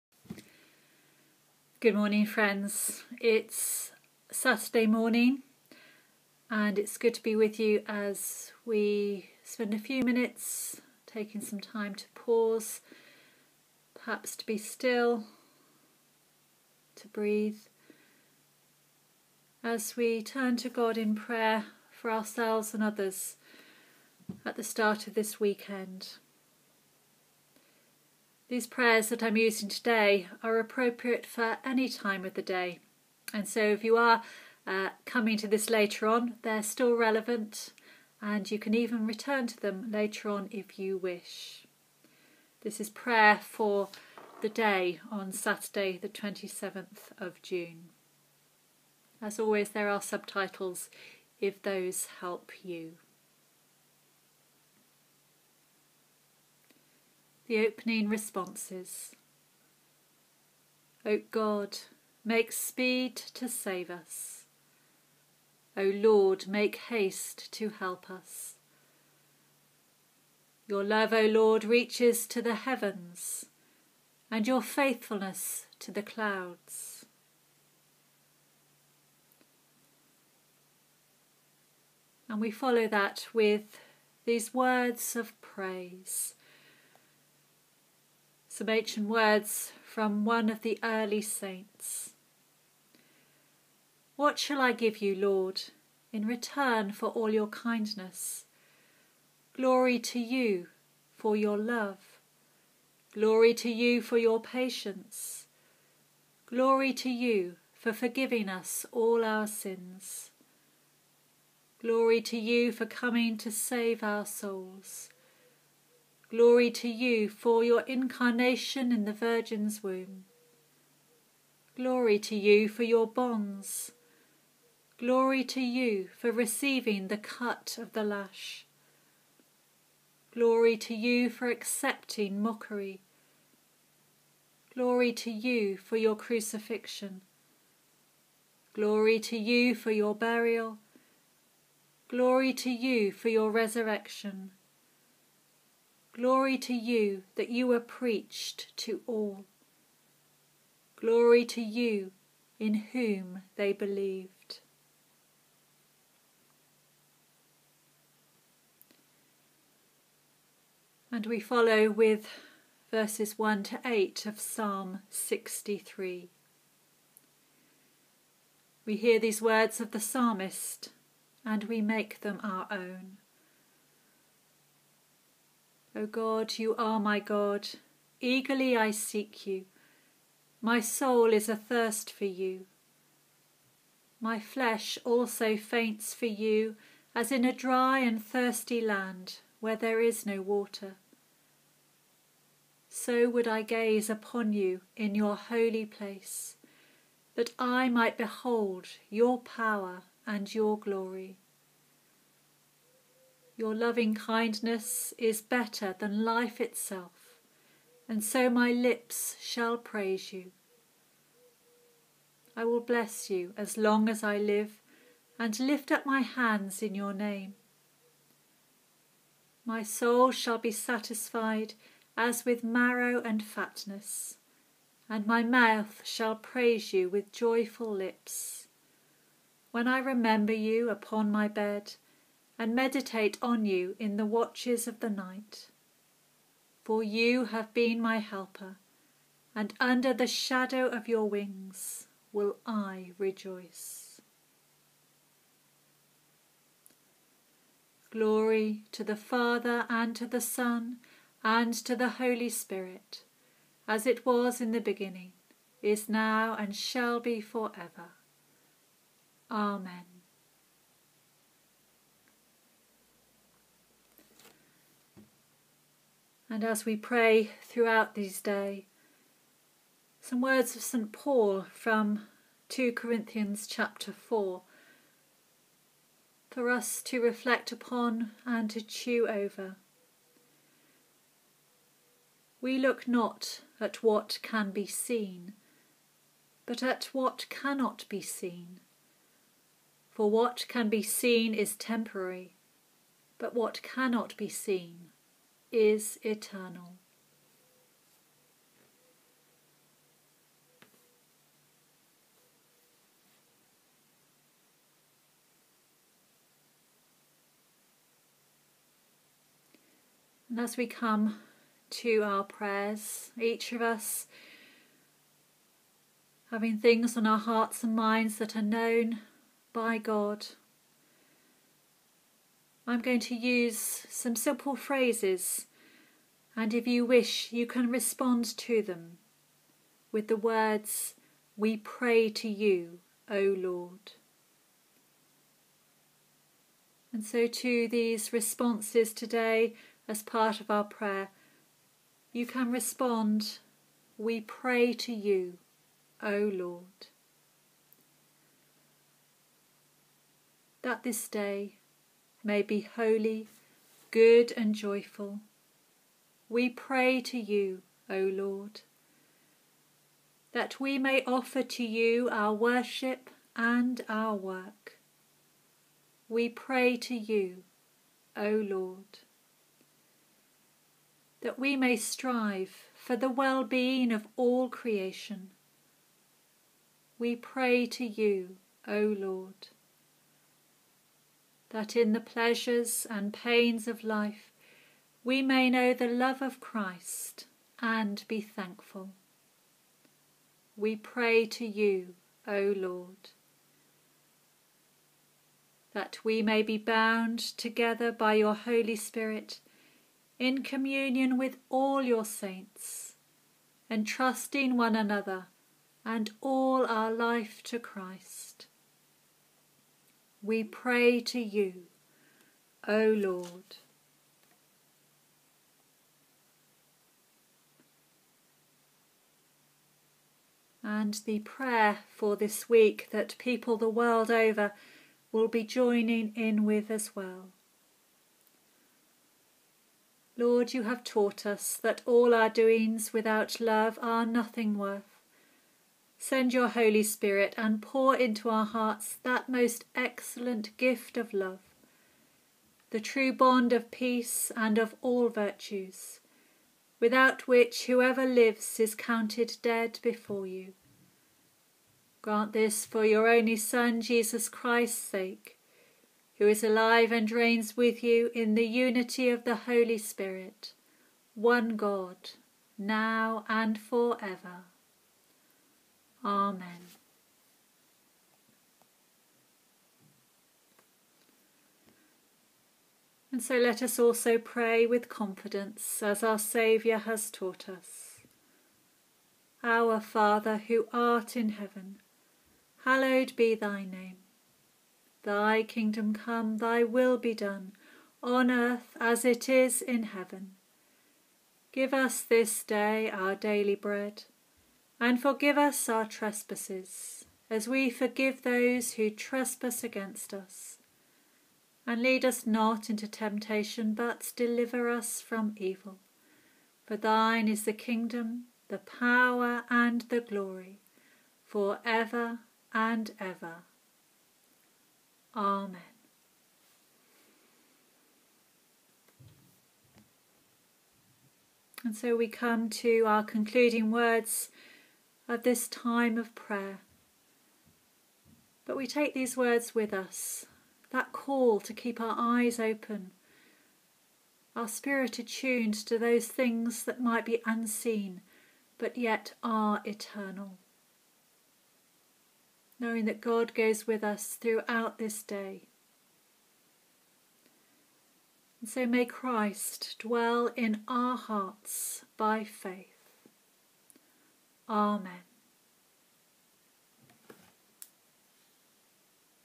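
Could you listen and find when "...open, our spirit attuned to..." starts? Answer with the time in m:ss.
8:52.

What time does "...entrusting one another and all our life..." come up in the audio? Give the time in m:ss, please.
6:43.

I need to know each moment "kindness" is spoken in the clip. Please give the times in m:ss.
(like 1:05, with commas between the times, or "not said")
1:37, 3:24.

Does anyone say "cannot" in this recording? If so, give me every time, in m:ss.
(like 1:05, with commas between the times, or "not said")
4:47, 4:53.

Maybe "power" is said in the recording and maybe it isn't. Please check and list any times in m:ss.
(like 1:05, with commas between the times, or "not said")
3:19, 8:28.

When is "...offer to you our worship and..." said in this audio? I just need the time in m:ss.
6:01.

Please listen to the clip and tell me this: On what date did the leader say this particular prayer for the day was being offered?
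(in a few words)
Saturday, 27 June.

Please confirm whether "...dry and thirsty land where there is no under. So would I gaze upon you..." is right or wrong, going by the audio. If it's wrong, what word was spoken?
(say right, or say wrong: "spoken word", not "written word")
wrong: "water", not "under".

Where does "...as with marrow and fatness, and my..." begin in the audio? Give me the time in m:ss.
3:42.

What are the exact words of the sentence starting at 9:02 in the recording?
Knowing that God goes with us throughout this day.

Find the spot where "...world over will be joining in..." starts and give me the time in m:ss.
7:03.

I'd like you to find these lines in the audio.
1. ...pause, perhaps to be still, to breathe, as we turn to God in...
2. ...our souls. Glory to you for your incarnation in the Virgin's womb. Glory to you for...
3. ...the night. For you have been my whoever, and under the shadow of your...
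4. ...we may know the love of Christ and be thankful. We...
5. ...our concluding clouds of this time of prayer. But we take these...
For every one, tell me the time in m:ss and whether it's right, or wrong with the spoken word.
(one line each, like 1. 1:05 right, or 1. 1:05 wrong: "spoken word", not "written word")
1. 0:12 right
2. 1:54 right
3. 3:54 wrong: "helper", not "whoever"
4. 6:25 right
5. 8:43 wrong: "words", not "clouds".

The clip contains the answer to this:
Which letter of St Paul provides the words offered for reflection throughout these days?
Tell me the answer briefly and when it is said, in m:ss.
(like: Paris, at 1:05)
2 Corinthians, at 4:32.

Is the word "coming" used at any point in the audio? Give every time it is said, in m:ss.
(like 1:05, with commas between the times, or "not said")
0:35, 1:52.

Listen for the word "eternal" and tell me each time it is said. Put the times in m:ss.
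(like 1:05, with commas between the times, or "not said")
4:56, 8:59.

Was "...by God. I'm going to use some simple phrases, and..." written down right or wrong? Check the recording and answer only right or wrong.
right.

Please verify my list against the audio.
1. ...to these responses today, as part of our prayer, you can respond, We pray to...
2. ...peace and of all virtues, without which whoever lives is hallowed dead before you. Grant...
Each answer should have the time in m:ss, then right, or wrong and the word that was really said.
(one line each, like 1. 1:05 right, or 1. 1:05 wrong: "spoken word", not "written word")
1. 5:37 right
2. 7:23 wrong: "counted", not "hallowed".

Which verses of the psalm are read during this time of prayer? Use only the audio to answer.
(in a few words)
1 to 8.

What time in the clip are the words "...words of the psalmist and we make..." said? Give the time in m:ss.
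2:49.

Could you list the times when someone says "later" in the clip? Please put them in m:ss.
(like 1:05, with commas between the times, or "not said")
0:35, 0:39.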